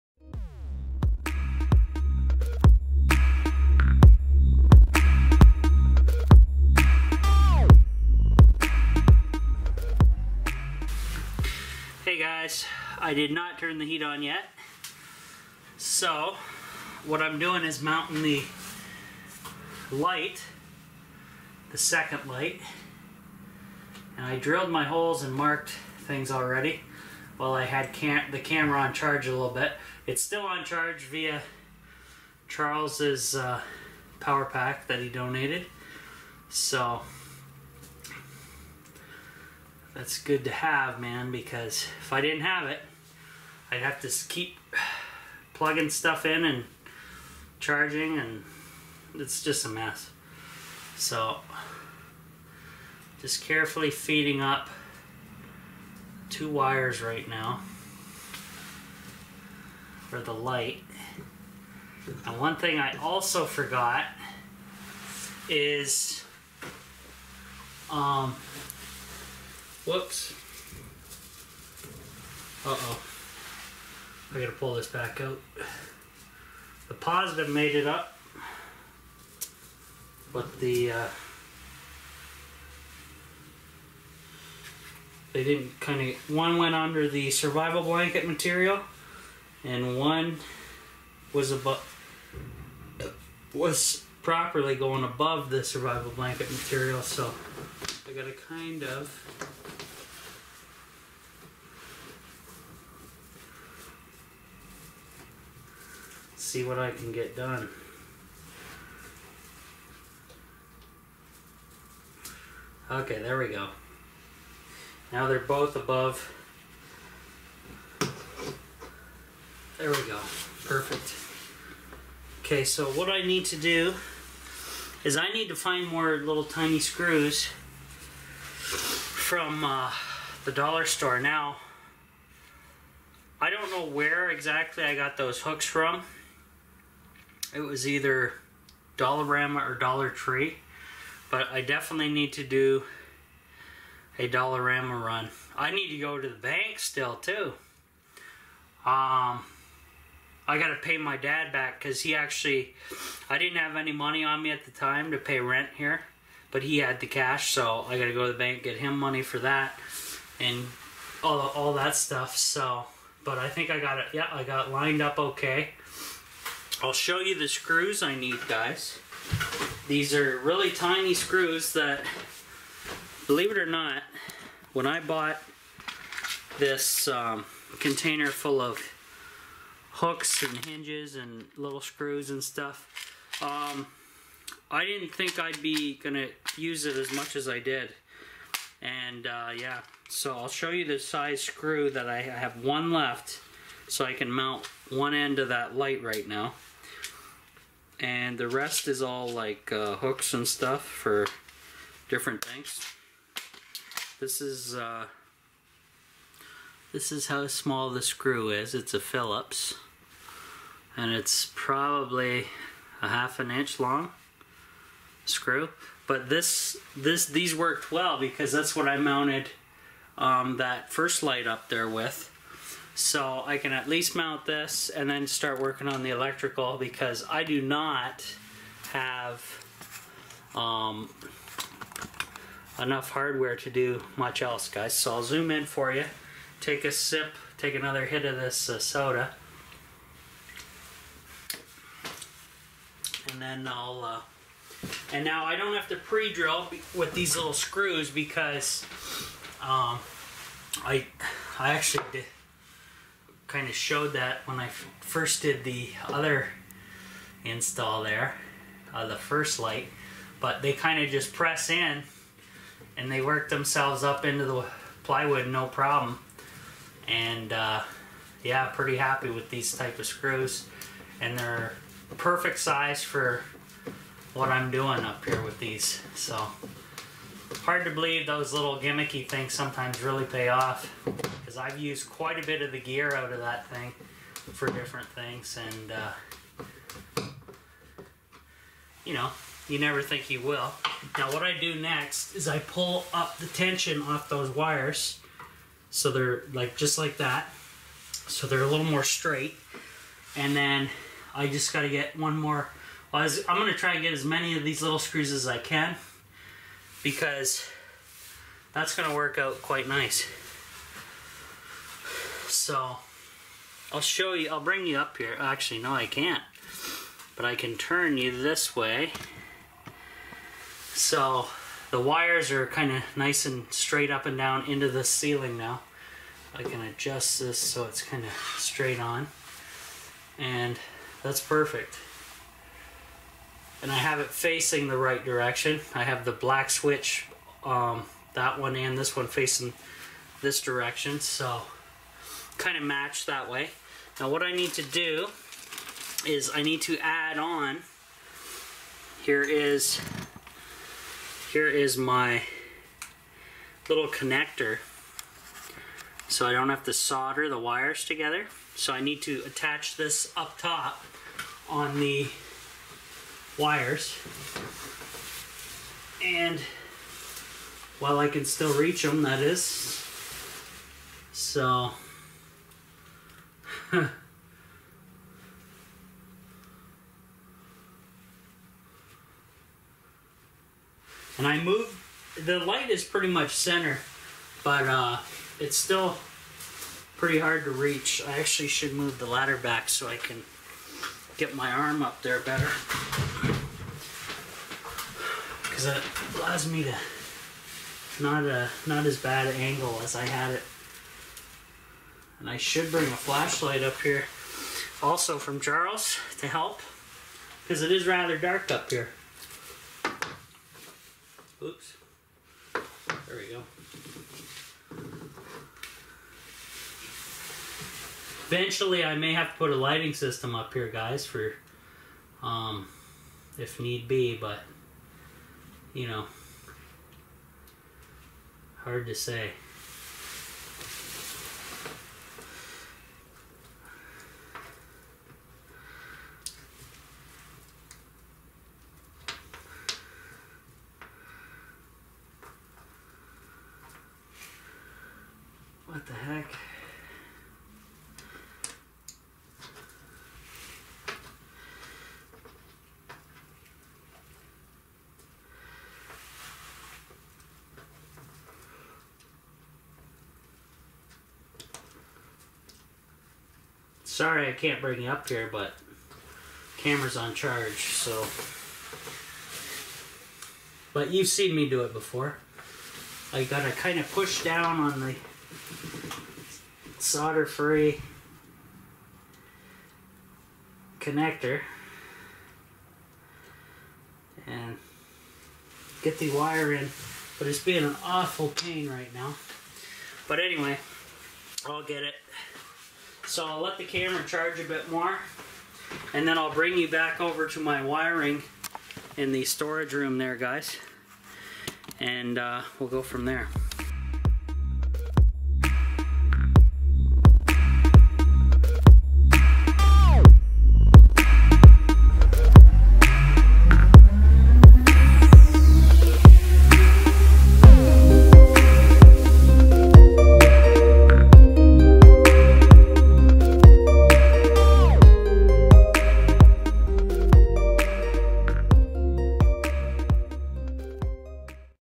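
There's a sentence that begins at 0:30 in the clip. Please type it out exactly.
It's still on charge via Charles's uh, power pack that he donated.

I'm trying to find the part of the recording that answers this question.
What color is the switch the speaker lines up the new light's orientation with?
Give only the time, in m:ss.
5:36.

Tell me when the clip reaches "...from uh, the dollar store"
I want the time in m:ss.
2:08.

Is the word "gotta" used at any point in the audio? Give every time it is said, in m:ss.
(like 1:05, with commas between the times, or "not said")
1:14, 1:38, 7:53.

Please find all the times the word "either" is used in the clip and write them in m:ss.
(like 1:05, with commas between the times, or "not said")
2:17.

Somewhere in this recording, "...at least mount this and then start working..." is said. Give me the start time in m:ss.
3:43.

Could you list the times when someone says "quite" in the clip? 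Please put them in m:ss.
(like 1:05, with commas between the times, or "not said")
4:42, 5:09.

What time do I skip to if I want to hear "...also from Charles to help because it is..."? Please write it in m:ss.
6:45.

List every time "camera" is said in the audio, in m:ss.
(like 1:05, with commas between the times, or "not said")
0:28, 7:46, 8:13.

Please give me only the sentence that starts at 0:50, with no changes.
So, just carefully feeding up two wires right now for the light.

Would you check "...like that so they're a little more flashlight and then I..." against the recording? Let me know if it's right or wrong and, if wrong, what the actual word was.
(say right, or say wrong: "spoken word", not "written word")
wrong: "straight", not "flashlight".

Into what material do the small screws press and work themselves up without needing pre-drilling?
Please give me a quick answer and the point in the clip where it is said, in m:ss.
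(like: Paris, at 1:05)
plywood, at 4:25.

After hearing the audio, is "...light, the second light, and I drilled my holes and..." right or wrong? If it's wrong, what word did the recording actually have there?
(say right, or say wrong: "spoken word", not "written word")
right.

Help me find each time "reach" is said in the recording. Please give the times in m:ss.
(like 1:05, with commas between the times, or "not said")
6:08, 6:27.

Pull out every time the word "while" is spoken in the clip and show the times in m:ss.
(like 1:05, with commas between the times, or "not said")
0:27, 6:07.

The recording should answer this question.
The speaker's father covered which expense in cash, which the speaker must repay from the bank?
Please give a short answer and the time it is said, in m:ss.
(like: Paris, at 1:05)
rent, at 2:35.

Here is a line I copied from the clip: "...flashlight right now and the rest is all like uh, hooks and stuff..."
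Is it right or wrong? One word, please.
wrong.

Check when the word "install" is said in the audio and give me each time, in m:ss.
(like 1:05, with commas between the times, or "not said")
4:17.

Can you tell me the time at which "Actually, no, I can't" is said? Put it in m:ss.
5:15.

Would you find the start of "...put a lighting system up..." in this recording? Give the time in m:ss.
6:59.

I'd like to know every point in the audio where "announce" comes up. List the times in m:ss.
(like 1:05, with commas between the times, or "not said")
not said.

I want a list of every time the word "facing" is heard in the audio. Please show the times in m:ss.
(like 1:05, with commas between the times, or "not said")
5:34, 5:39.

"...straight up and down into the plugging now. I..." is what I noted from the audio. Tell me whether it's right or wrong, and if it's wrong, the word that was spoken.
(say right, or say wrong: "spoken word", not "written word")
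wrong: "ceiling", not "plugging".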